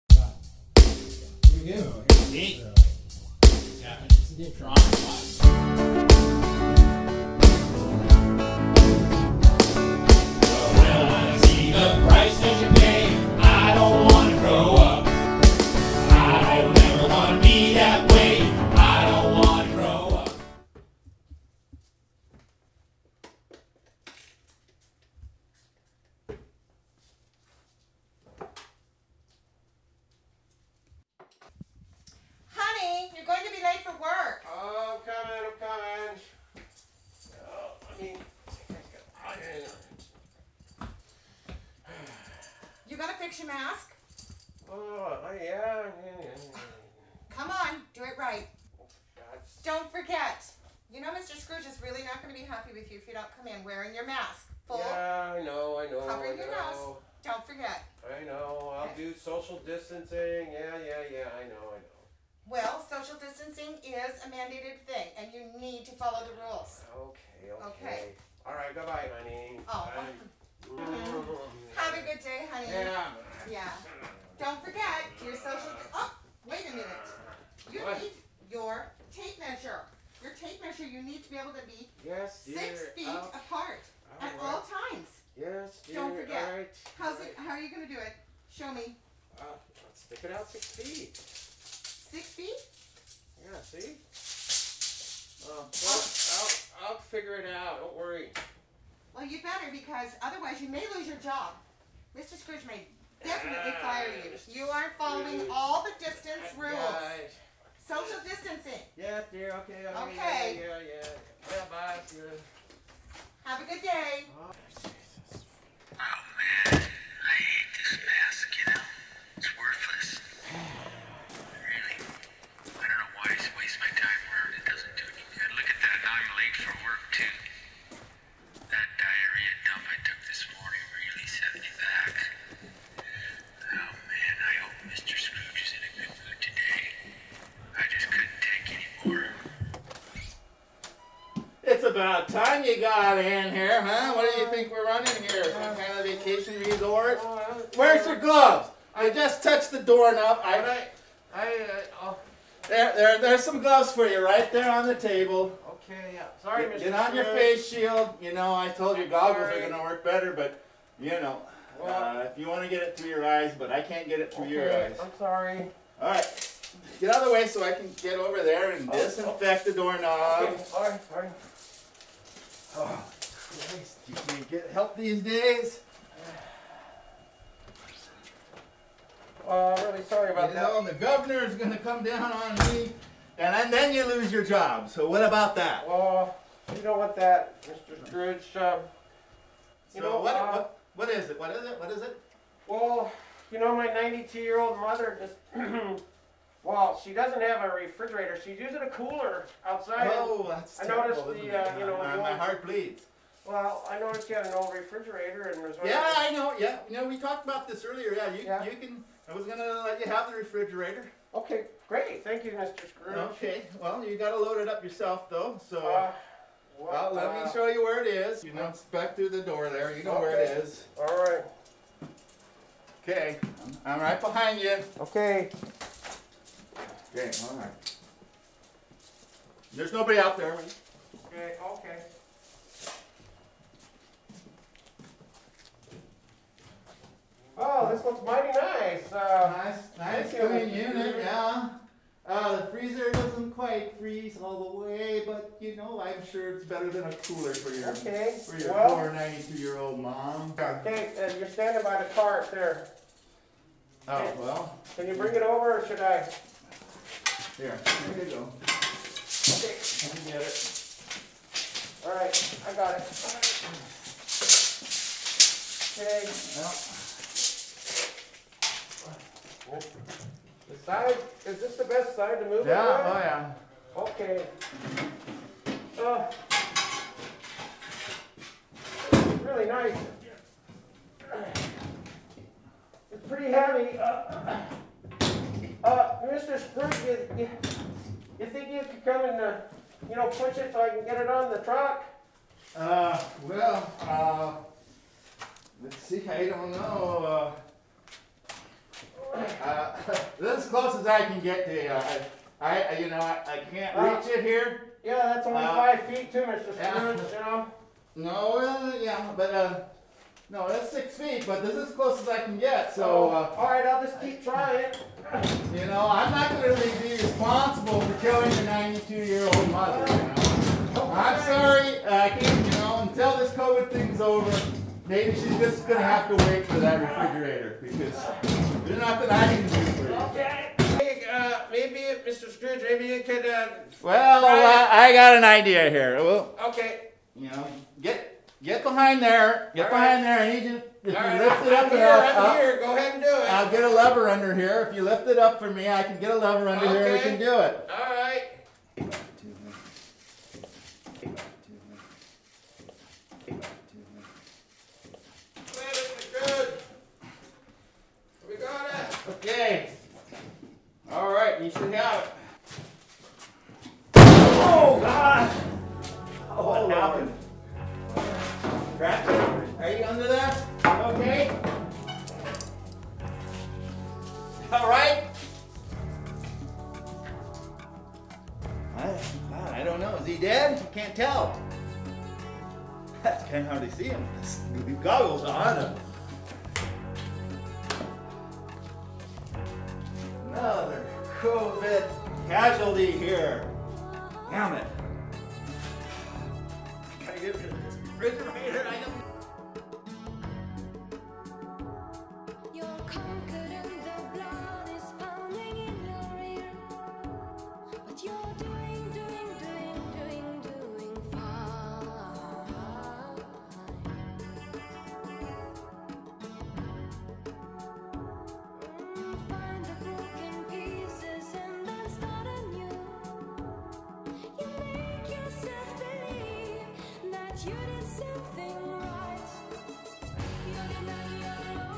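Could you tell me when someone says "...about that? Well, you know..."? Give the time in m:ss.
3:05.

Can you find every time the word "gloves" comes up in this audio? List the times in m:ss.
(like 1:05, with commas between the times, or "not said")
2:28, 2:33.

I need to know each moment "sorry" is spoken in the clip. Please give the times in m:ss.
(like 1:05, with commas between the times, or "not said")
2:36, 2:45, 2:50, 3:00, 5:21.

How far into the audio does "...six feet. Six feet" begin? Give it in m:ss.
1:30.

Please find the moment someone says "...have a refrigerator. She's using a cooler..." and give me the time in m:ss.
3:17.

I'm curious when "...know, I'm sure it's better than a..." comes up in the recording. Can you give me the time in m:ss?
4:05.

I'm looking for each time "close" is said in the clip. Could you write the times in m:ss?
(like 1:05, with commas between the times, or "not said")
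5:00, 5:11.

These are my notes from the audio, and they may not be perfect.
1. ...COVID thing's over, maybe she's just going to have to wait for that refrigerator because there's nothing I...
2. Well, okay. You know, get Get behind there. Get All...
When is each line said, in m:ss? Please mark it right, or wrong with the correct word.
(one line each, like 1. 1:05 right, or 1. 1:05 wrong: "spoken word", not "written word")
1. 5:23 right
2. 5:36 right.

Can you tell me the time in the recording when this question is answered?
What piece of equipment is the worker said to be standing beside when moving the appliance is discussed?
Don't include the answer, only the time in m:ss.
4:12.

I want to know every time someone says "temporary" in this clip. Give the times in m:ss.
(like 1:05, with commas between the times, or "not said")
not said.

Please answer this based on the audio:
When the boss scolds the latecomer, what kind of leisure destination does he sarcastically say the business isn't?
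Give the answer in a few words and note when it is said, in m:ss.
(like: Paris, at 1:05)
vacation resort, at 2:26.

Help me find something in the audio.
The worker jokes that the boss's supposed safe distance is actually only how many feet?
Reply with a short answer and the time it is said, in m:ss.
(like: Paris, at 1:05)
5, at 5:05.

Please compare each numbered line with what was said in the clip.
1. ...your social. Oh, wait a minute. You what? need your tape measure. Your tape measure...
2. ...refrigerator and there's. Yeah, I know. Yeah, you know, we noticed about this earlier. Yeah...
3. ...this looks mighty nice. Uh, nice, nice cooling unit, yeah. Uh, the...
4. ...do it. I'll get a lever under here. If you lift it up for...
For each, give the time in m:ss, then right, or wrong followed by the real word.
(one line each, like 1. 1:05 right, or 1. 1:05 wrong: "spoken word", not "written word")
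1. 1:15 right
2. 3:24 wrong: "talked", not "noticed"
3. 3:57 right
4. 5:43 right.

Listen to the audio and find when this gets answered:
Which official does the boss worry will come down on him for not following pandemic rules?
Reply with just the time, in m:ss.
3:00.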